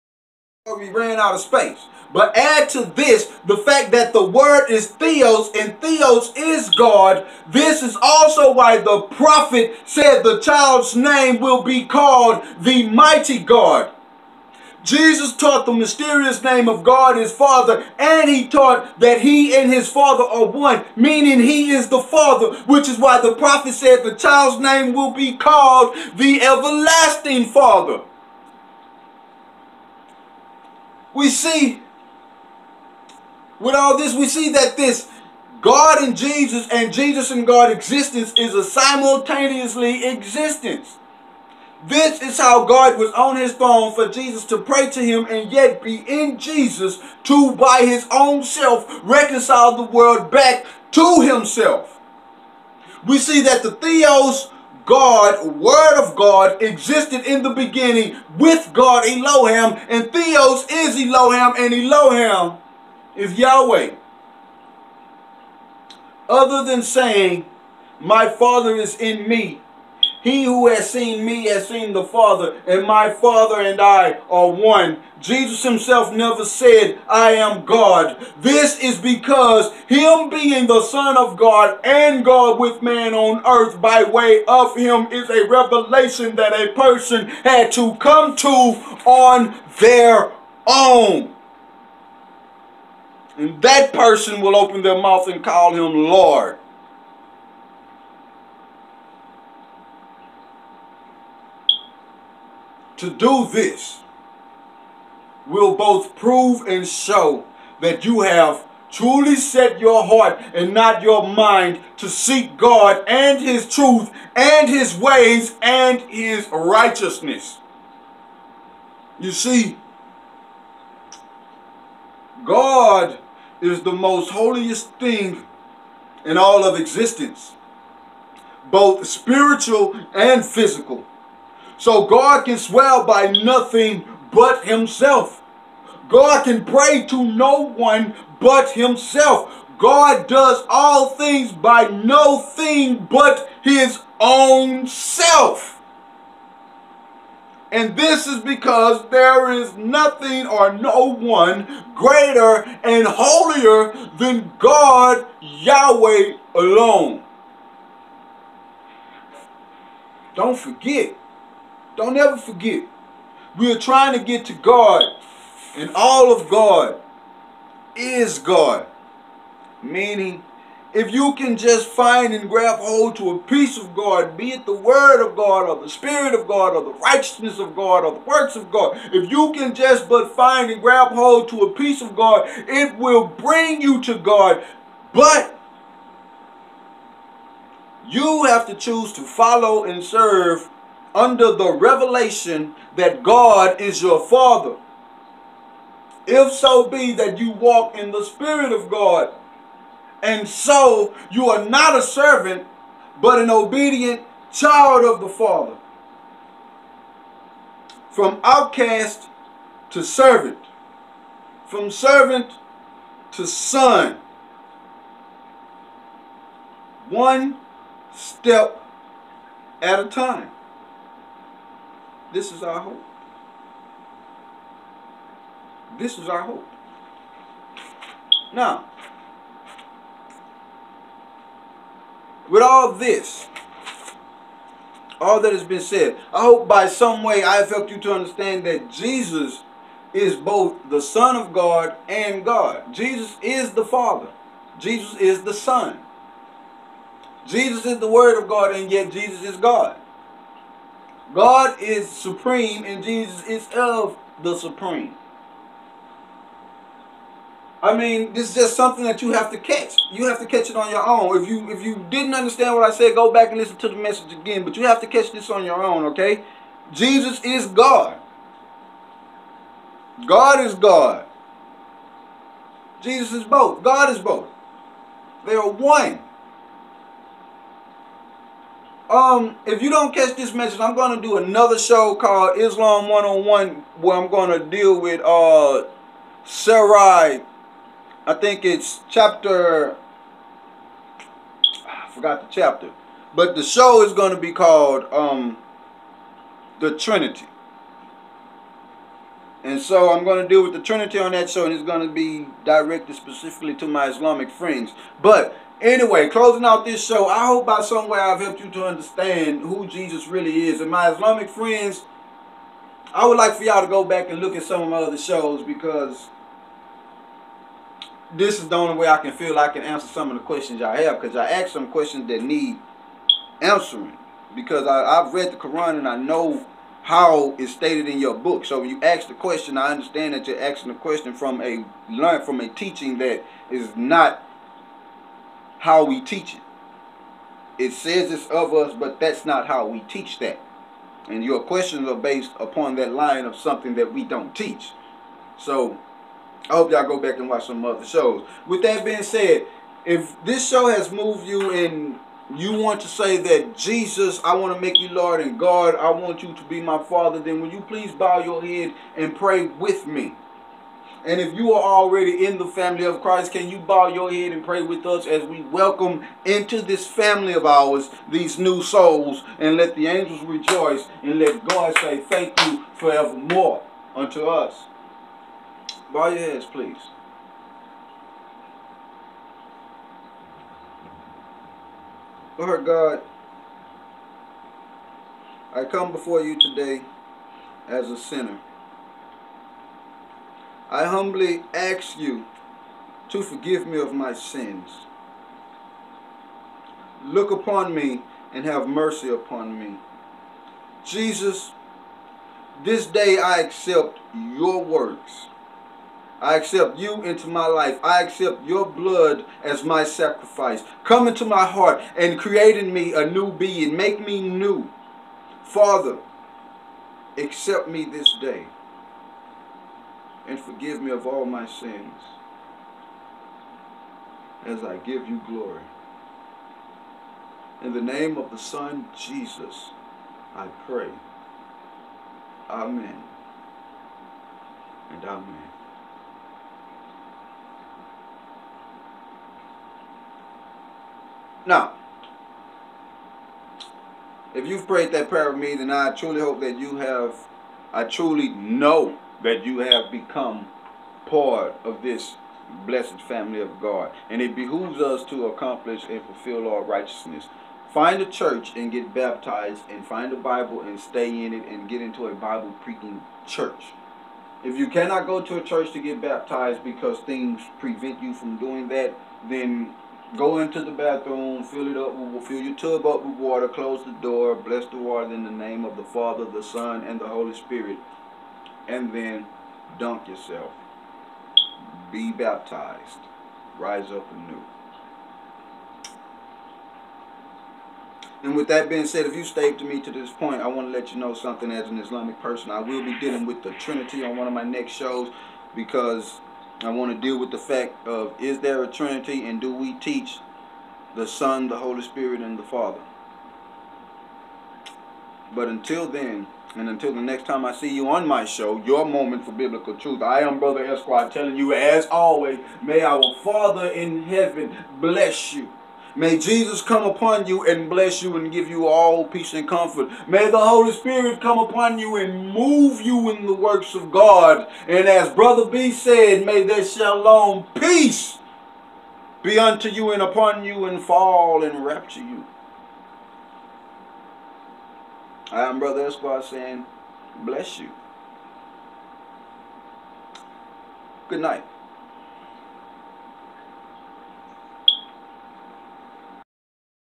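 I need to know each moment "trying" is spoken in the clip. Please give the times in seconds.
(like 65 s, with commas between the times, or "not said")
163 s.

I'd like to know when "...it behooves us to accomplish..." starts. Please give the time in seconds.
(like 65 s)
454 s.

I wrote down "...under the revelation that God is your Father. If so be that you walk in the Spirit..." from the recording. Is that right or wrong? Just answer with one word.
right.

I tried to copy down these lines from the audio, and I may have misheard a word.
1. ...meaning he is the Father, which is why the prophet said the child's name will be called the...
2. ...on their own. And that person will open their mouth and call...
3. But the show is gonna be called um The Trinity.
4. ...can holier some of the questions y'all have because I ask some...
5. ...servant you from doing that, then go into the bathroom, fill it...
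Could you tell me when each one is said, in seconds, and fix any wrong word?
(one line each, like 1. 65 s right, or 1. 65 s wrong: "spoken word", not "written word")
1. 20 s right
2. 88 s right
3. 293 s right
4. 319 s wrong: "answer", not "holier"
5. 467 s wrong: "prevent", not "servant".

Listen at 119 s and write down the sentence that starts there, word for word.
You see, God is the most holiest thing in all of existence, both spiritual and physical.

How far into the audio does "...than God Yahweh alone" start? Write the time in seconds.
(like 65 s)
154 s.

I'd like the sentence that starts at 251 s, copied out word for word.
God is supreme and Jesus is of the supreme.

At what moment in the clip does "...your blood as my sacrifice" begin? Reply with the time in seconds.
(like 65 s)
408 s.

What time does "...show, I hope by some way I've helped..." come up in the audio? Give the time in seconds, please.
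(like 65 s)
307 s.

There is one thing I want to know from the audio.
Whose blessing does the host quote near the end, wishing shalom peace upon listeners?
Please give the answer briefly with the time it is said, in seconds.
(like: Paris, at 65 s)
Brother B, at 525 s.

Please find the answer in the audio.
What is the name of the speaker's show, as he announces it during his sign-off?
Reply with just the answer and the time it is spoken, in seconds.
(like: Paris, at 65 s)
your moment for biblical truth, at 508 s.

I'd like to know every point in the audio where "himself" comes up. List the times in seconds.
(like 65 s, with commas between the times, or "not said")
51 s, 75 s, 134 s, 138 s.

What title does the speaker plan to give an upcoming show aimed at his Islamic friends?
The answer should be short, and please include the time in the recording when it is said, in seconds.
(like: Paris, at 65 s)
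Islam 101, at 282 s.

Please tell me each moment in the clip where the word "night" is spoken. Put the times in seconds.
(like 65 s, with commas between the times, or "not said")
541 s.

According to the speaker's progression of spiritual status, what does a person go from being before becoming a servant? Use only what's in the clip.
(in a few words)
outcast.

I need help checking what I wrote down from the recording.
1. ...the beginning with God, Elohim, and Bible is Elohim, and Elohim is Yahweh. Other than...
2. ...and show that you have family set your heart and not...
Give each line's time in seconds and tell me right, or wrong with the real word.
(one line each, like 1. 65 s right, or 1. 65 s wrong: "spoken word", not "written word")
1. 57 s wrong: "Theos", not "Bible"
2. 106 s wrong: "truly", not "family".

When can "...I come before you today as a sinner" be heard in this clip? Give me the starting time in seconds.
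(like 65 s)
385 s.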